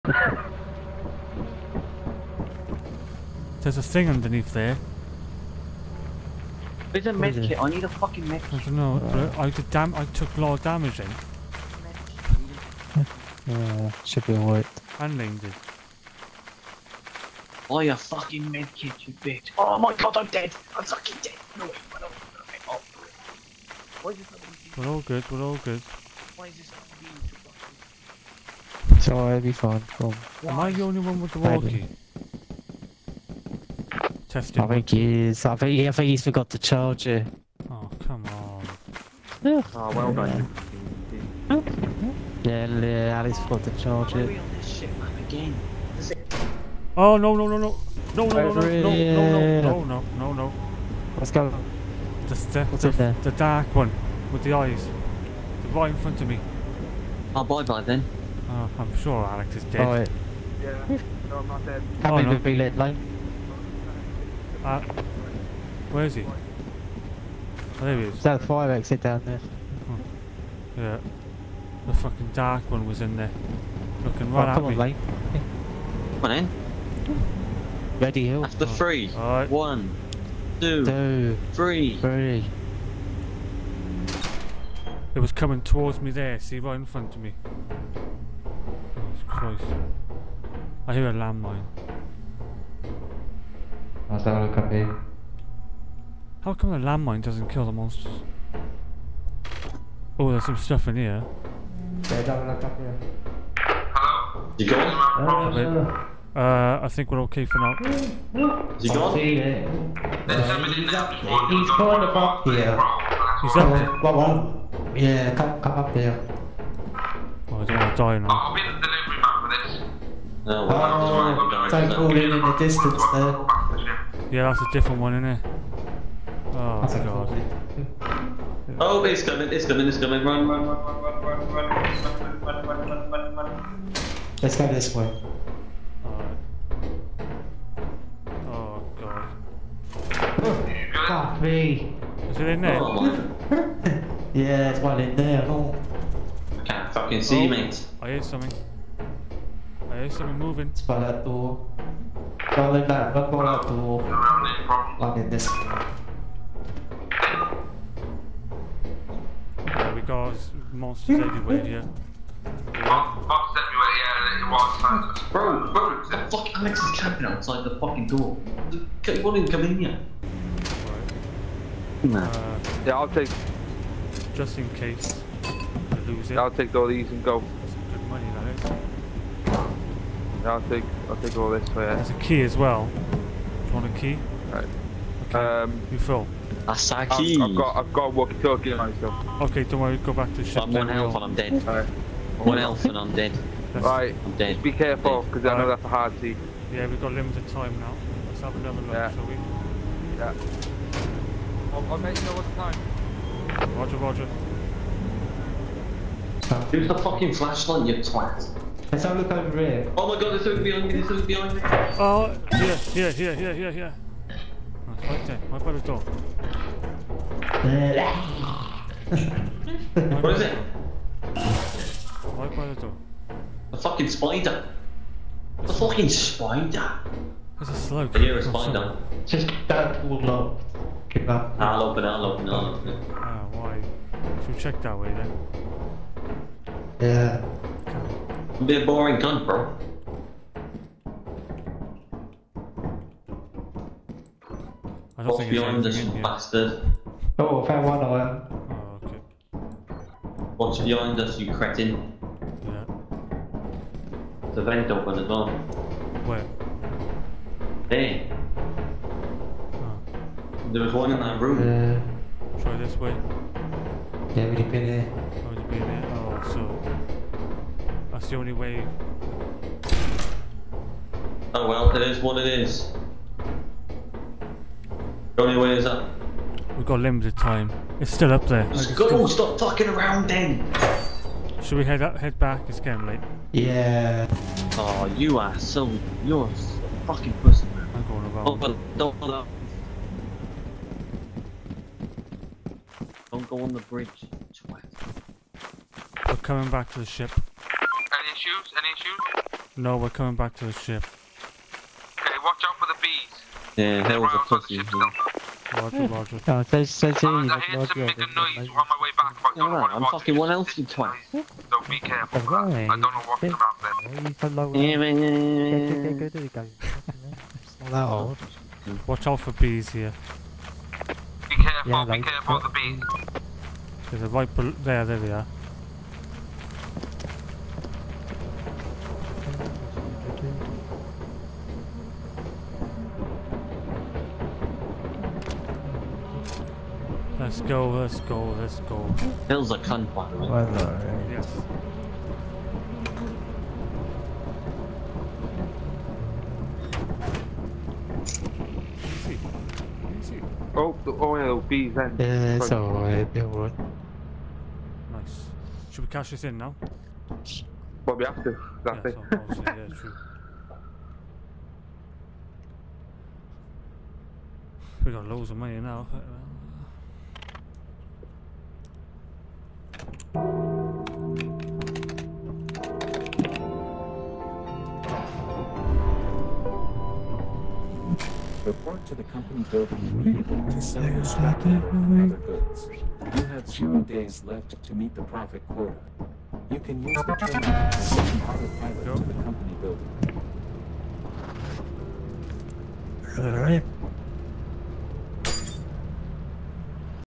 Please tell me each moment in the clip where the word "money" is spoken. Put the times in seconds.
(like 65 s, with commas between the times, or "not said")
178 s, 365 s.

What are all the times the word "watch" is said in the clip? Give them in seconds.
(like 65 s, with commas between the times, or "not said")
302 s, 319 s.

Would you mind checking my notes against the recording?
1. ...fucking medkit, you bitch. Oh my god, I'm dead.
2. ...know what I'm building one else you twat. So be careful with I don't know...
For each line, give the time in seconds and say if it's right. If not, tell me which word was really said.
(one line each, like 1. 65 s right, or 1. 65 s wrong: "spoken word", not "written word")
1. 17 s right
2. 309 s wrong: "fucking", not "building".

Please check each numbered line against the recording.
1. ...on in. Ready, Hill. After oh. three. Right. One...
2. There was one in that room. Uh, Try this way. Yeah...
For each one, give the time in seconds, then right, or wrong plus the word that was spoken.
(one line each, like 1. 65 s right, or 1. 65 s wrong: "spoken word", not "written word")
1. 76 s right
2. 260 s right.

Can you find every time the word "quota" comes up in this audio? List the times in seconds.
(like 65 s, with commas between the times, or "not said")
385 s.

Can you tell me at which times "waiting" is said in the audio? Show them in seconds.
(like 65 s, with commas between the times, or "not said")
not said.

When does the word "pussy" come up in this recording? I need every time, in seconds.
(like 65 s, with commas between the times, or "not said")
287 s, 304 s.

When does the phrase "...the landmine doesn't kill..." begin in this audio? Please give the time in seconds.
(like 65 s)
96 s.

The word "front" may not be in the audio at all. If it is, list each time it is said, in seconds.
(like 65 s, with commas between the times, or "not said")
55 s, 86 s.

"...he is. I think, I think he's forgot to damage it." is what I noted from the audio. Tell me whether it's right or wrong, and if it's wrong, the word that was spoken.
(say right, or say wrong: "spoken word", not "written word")
wrong: "charge", not "damage".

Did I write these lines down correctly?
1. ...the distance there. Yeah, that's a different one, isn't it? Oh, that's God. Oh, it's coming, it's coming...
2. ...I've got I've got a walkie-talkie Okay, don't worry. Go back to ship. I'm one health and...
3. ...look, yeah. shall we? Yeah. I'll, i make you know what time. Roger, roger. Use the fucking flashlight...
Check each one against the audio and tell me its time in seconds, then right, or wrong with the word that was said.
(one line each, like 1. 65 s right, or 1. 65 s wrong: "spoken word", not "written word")
1. 122 s right
2. 187 s right
3. 198 s right.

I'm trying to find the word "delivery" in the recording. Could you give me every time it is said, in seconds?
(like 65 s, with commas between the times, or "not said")
118 s.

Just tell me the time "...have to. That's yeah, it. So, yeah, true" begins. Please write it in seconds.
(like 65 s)
358 s.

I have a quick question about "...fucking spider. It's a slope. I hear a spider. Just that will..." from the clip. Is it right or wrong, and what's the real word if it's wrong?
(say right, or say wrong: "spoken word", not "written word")
right.